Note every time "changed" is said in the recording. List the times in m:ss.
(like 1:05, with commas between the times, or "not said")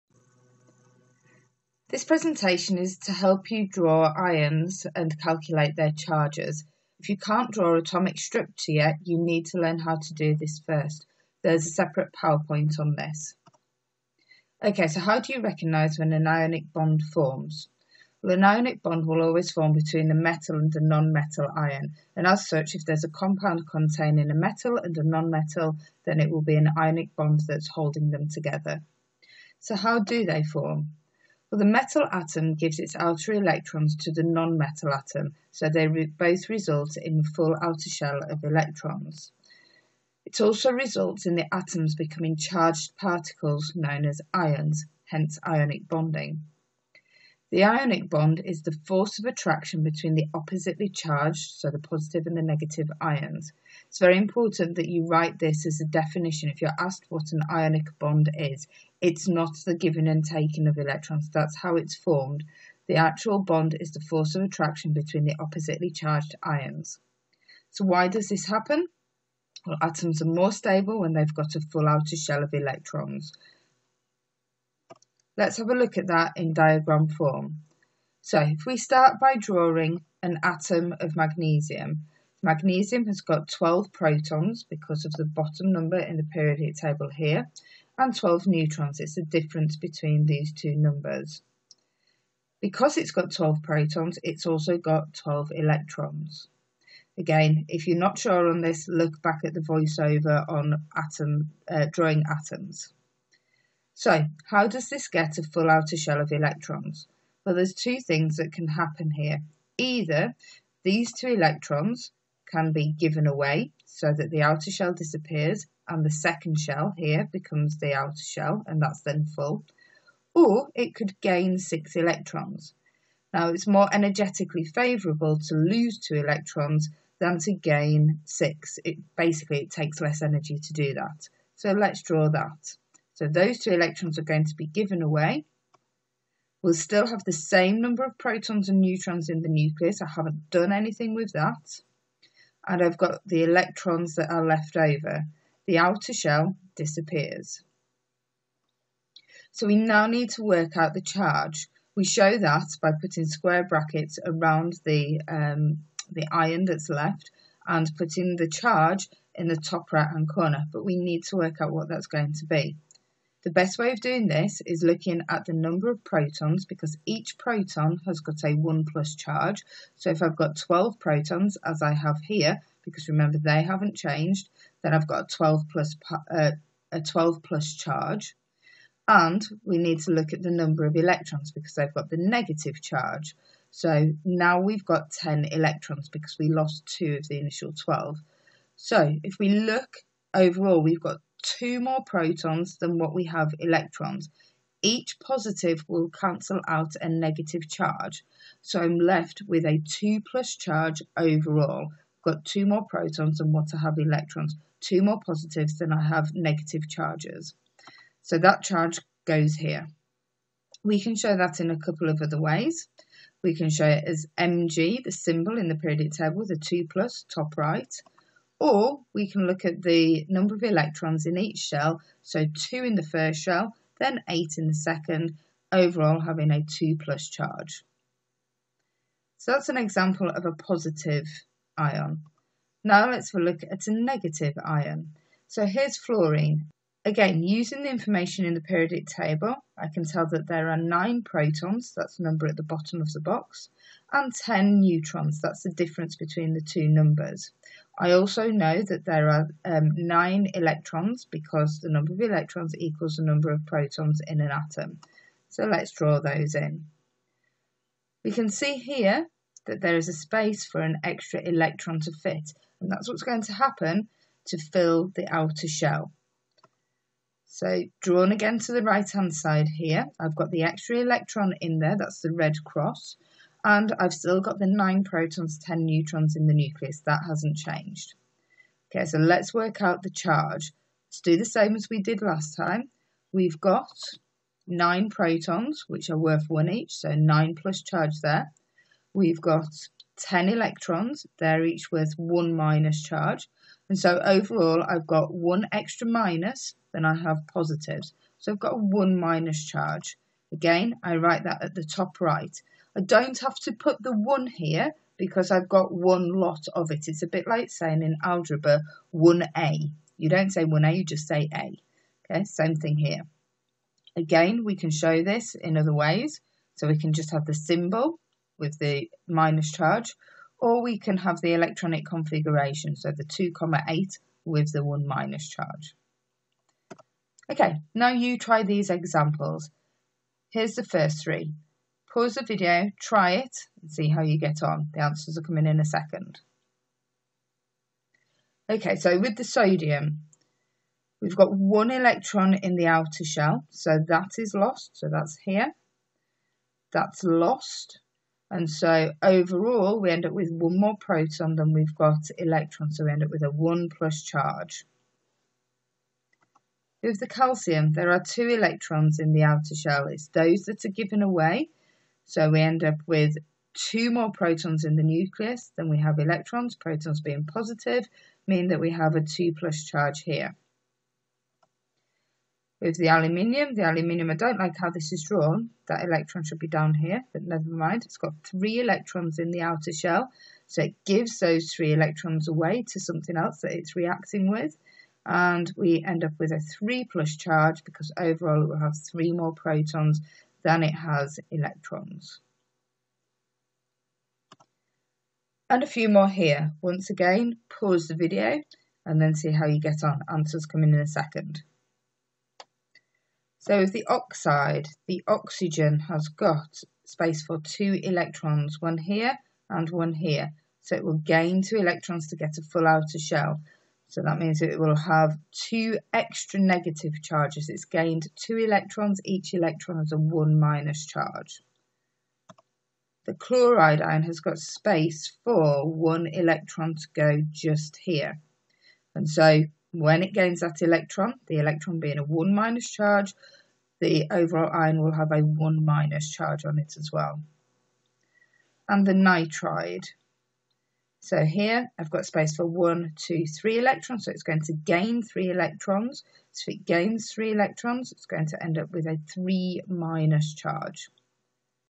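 2:53, 4:37.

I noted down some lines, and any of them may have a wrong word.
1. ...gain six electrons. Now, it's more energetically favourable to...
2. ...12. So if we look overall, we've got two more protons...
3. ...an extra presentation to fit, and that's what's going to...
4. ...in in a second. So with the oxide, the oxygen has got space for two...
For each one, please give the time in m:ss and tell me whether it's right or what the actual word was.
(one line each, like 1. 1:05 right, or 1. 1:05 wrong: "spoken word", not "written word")
1. 2:01 right
2. 3:07 right
3. 4:20 wrong: "electron", not "presentation"
4. 6:40 right.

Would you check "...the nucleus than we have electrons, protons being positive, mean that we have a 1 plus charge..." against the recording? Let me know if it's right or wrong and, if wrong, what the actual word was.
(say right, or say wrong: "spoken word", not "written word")
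wrong: "2", not "1".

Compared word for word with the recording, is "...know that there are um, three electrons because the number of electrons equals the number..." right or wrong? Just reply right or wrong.
wrong.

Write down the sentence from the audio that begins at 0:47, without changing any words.
The ionic bond is the force of attraction between the oppositely charged, so the positive and the negative ions.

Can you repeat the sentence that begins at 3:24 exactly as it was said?
Two more positives than I have negative charges.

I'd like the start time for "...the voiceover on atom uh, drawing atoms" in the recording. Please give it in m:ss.
1:39.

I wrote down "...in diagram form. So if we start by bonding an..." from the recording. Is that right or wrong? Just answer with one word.
wrong.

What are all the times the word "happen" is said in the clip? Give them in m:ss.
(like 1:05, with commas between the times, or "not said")
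1:08, 1:48, 4:23.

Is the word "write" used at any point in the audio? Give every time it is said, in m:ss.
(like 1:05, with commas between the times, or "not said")
0:55, 5:01.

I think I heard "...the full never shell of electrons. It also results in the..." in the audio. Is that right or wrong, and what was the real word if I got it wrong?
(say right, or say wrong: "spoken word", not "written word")
wrong: "outer", not "never".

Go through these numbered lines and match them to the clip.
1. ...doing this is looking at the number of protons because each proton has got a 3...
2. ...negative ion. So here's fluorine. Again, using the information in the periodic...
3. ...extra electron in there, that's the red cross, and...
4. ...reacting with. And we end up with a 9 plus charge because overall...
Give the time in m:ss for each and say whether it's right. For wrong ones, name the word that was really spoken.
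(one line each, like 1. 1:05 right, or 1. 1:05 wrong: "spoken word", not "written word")
1. 2:44 wrong: "1", not "3"
2. 3:53 right
3. 4:30 right
4. 6:23 wrong: "3", not "9".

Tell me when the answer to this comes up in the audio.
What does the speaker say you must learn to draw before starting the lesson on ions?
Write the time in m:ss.
0:07.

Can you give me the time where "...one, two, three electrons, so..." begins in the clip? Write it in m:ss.
7:22.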